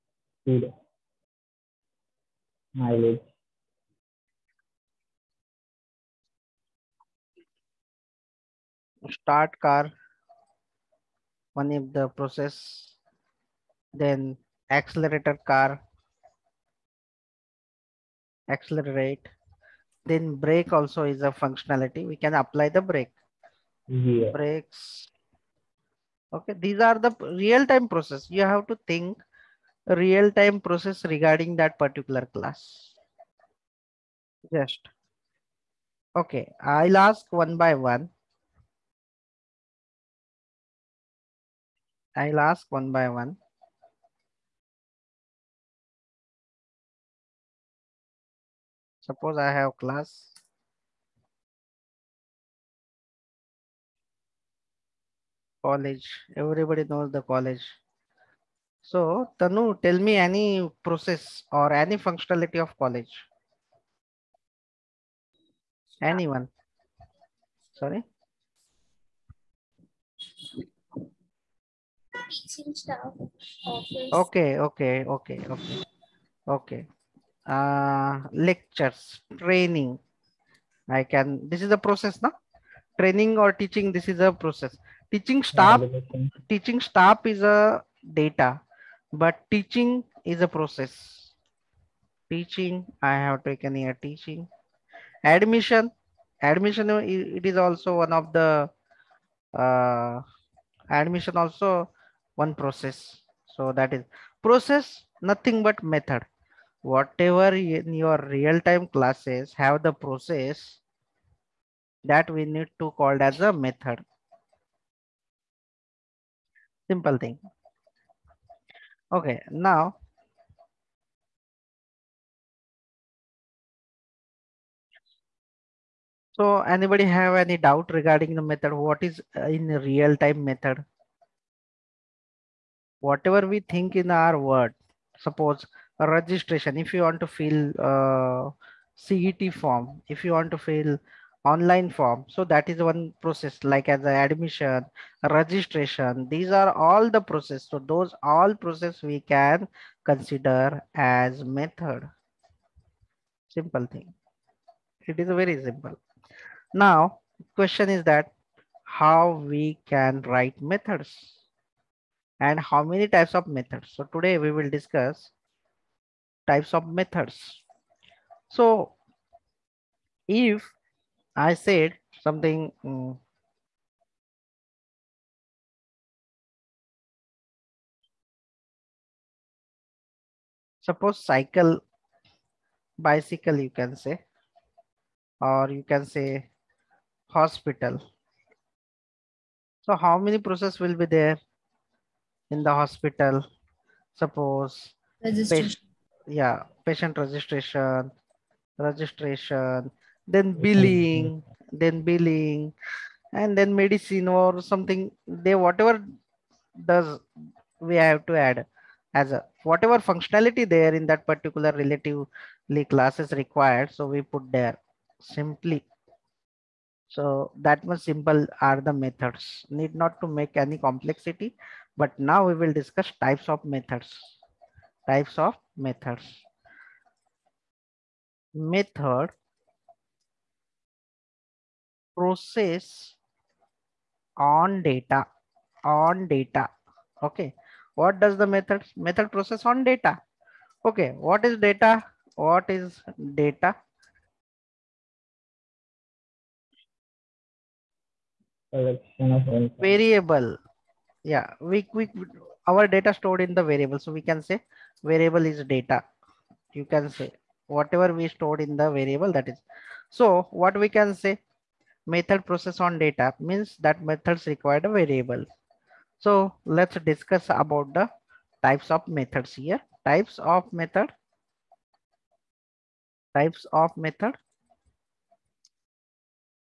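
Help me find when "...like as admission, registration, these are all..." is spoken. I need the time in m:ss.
2:23.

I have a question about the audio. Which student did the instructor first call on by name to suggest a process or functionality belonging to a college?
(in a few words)
Tanu.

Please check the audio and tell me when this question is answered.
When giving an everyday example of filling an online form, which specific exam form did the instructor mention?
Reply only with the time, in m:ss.
2:18.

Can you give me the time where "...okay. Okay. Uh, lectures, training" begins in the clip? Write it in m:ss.
1:15.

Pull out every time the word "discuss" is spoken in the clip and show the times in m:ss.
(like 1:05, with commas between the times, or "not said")
2:44, 3:42, 4:27.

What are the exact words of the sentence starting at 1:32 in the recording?
Teaching, I have taken here teaching.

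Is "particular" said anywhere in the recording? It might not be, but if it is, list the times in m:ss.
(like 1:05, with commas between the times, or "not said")
0:31, 3:31.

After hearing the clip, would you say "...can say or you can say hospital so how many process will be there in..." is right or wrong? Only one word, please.
right.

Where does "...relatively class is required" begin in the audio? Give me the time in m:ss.
3:31.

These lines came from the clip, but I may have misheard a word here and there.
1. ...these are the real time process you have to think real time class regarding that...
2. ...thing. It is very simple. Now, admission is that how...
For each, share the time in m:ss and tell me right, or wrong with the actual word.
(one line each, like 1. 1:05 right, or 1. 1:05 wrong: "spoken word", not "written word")
1. 0:26 wrong: "process", not "class"
2. 2:33 wrong: "question", not "admission".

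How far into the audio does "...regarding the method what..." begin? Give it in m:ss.
2:07.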